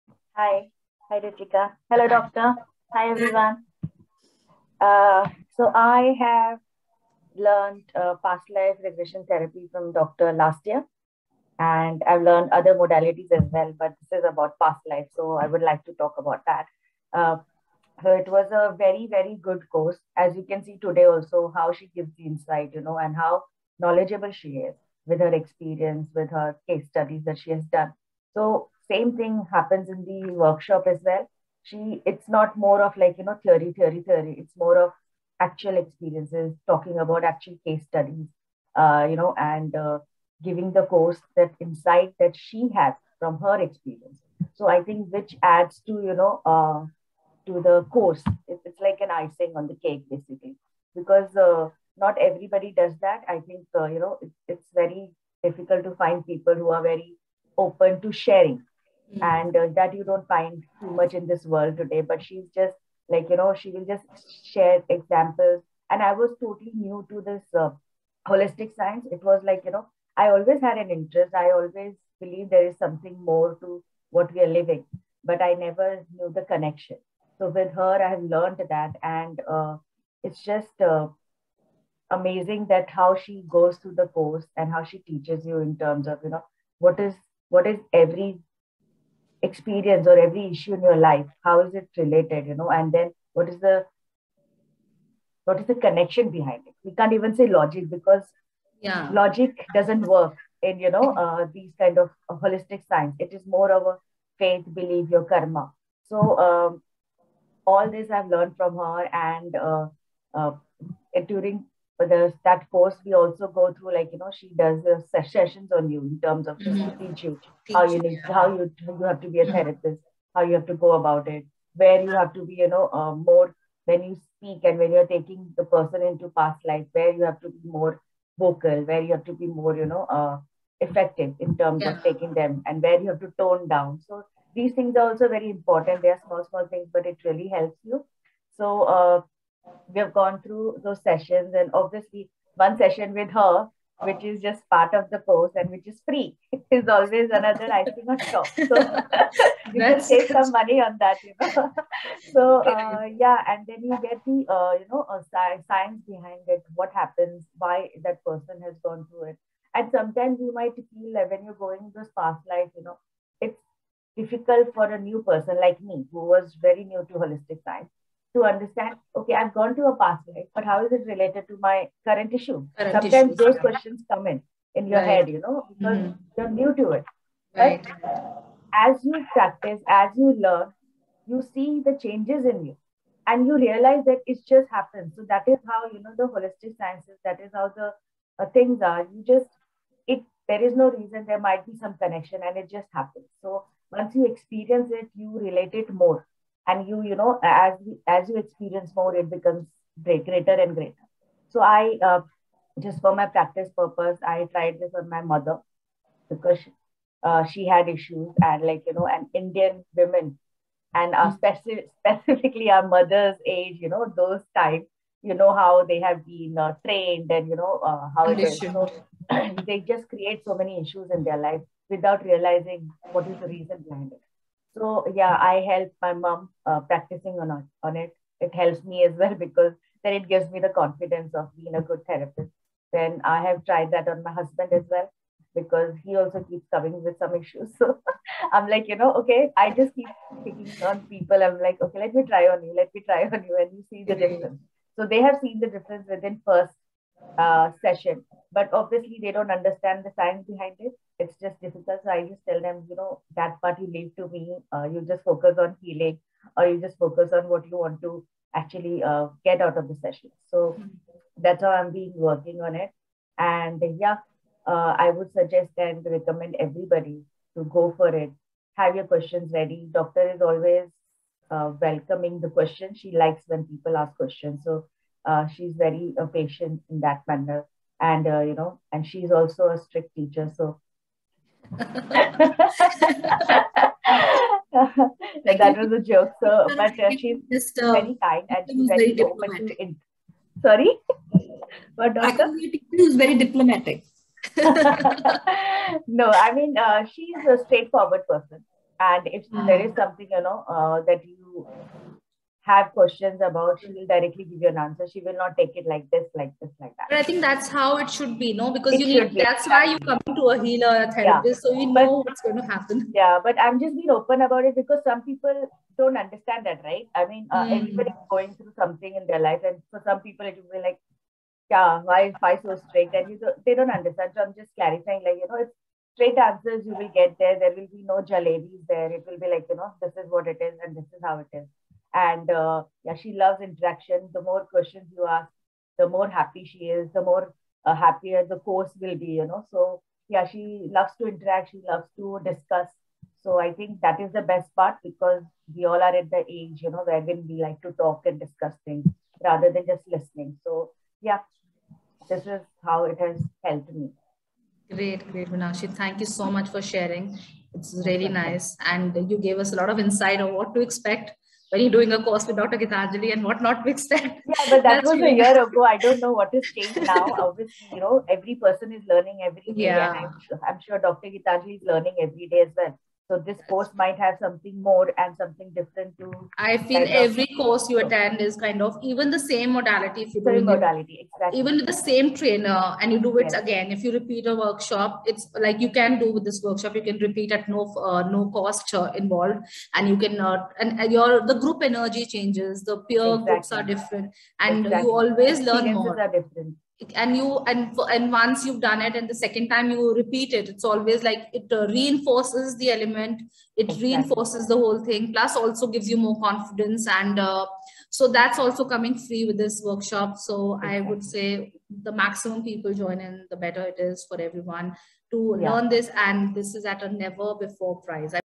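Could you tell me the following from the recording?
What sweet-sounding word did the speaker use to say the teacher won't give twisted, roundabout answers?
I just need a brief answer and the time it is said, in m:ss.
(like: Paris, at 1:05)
jalebis, at 5:28.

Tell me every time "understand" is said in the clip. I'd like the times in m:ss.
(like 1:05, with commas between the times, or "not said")
2:48, 4:09, 5:16, 5:23.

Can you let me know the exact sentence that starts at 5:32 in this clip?
And uh, yeah, she loves interaction.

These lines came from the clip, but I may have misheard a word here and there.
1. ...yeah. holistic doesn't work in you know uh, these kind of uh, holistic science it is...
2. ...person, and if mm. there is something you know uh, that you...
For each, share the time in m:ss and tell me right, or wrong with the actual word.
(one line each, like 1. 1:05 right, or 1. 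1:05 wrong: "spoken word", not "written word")
1. 1:38 wrong: "logic", not "holistic"
2. 4:58 right.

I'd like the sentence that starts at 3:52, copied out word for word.
Then I have tried that on my husband as well because he also keeps coming with some issues.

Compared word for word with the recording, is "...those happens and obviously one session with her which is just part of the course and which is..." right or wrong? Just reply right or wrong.
wrong.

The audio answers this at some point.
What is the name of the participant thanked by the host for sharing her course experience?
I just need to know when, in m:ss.
5:55.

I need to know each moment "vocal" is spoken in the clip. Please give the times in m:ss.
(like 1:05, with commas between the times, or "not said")
2:08.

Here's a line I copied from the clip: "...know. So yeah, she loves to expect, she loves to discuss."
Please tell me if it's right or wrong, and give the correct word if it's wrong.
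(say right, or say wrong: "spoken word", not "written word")
wrong: "interact", not "expect".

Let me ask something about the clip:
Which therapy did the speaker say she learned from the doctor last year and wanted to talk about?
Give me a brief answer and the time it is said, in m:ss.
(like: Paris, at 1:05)
Past life regression therapy, at 0:08.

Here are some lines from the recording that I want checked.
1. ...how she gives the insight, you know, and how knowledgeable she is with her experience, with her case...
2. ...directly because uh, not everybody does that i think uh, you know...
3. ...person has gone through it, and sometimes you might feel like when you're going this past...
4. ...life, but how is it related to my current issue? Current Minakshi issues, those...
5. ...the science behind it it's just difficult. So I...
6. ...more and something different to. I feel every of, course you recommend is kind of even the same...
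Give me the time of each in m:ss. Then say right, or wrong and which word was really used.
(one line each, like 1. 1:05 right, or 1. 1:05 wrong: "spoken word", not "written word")
1. 0:21 right
2. 0:50 wrong: "basically", not "directly"
3. 2:38 right
4. 2:50 wrong: "Sometimes", not "Minakshi"
5. 4:10 right
6. 6:14 wrong: "attend", not "recommend".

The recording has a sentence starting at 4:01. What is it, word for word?
I'm like, okay, let me try on you, let me try on you, and you see the difference.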